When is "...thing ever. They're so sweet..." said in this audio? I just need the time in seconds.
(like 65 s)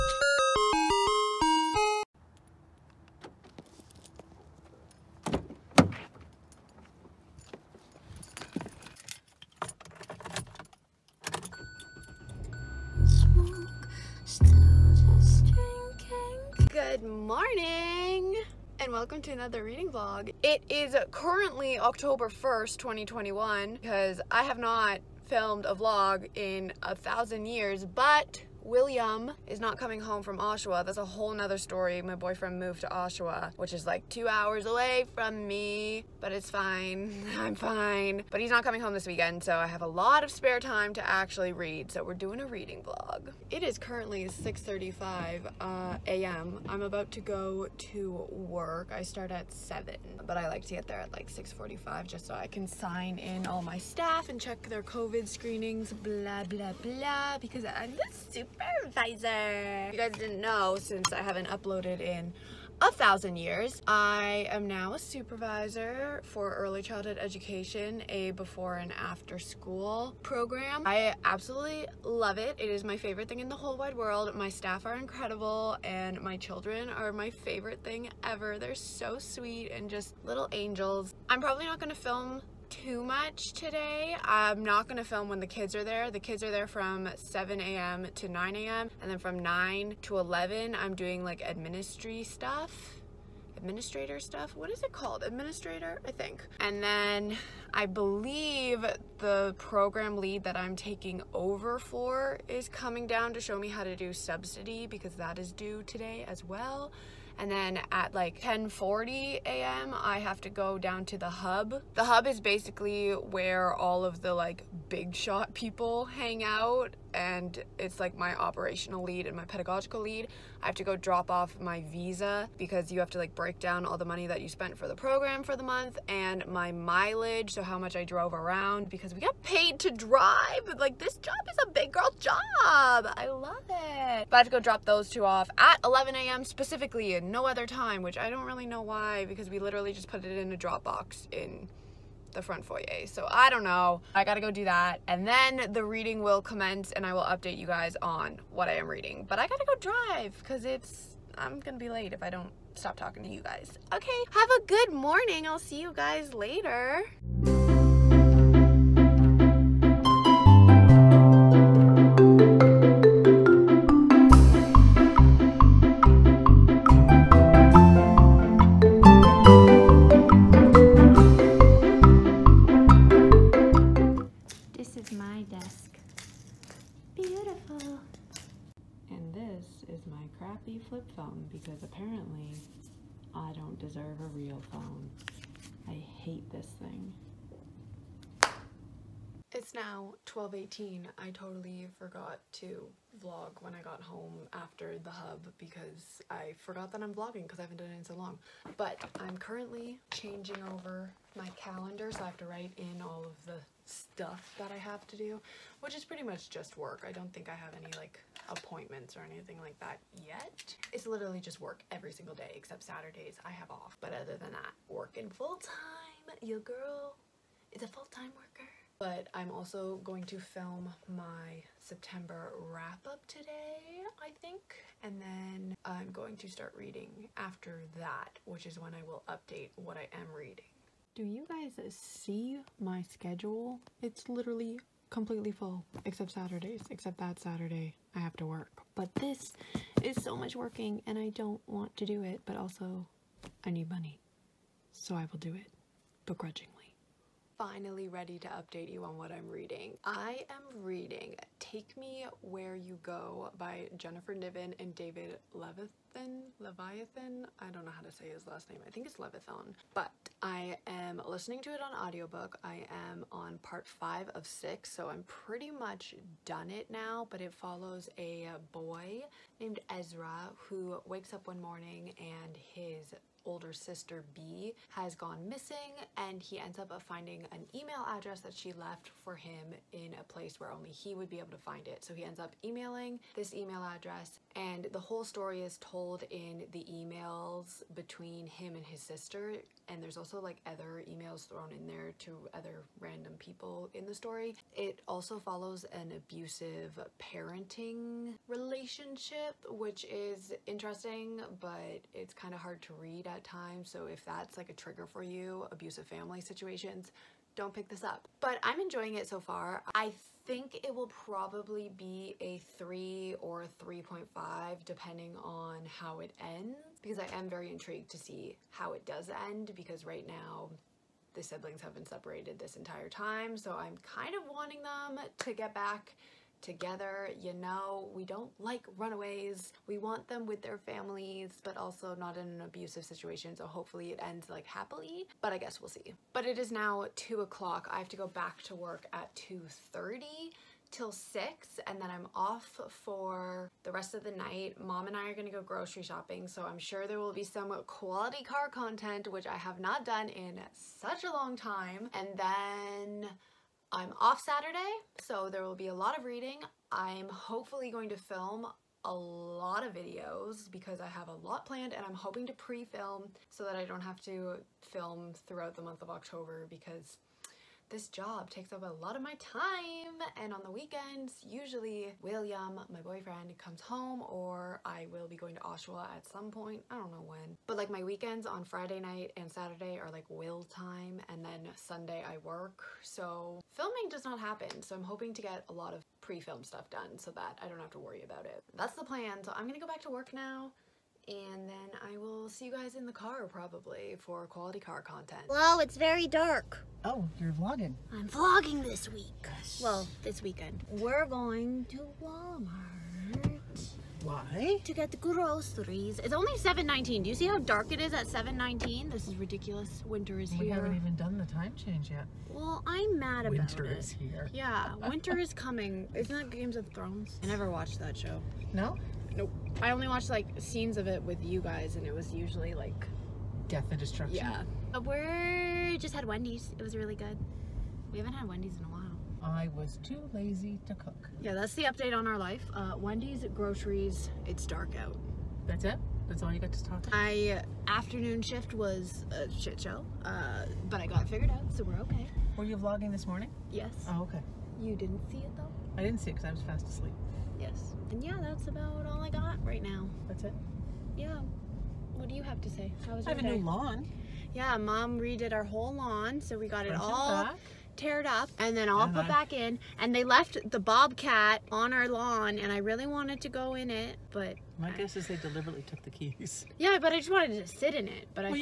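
77 s.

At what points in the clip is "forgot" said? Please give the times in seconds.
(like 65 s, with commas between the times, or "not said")
191 s, 196 s.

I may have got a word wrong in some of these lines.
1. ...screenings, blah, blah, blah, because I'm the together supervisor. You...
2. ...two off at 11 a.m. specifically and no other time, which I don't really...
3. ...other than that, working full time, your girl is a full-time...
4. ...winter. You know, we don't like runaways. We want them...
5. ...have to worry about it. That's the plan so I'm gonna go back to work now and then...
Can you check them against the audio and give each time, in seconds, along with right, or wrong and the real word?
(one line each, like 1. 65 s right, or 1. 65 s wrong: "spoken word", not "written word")
1. 55 s wrong: "super", not "together"
2. 135 s right
3. 214 s right
4. 326 s wrong: "together", not "winter"
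5. 387 s right.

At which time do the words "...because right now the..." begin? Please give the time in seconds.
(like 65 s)
319 s.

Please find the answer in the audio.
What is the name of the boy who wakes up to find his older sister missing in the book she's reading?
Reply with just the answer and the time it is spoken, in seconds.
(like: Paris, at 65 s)
Ezra, at 269 s.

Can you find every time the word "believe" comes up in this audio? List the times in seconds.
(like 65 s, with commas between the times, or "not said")
97 s.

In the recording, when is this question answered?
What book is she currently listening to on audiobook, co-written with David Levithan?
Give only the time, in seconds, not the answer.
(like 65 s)
251 s.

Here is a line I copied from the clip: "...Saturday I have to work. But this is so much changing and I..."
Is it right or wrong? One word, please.
wrong.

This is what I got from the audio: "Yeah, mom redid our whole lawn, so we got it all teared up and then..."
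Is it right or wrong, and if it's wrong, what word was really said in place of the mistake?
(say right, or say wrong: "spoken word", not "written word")
right.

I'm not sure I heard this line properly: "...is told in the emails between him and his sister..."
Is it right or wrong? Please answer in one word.
right.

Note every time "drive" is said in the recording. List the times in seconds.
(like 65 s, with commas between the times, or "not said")
129 s, 149 s.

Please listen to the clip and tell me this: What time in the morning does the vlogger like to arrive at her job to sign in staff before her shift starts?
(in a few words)
6:45.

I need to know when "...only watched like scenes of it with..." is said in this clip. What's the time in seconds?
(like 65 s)
419 s.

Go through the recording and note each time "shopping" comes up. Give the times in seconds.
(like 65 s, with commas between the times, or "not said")
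346 s.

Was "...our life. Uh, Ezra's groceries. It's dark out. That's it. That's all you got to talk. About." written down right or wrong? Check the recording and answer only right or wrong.
wrong.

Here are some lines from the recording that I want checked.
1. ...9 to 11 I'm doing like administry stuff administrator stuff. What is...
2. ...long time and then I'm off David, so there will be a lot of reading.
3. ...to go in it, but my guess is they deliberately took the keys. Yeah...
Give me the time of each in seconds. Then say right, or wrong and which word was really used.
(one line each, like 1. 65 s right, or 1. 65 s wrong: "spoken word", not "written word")
1. 89 s right
2. 351 s wrong: "Saturday", not "David"
3. 463 s right.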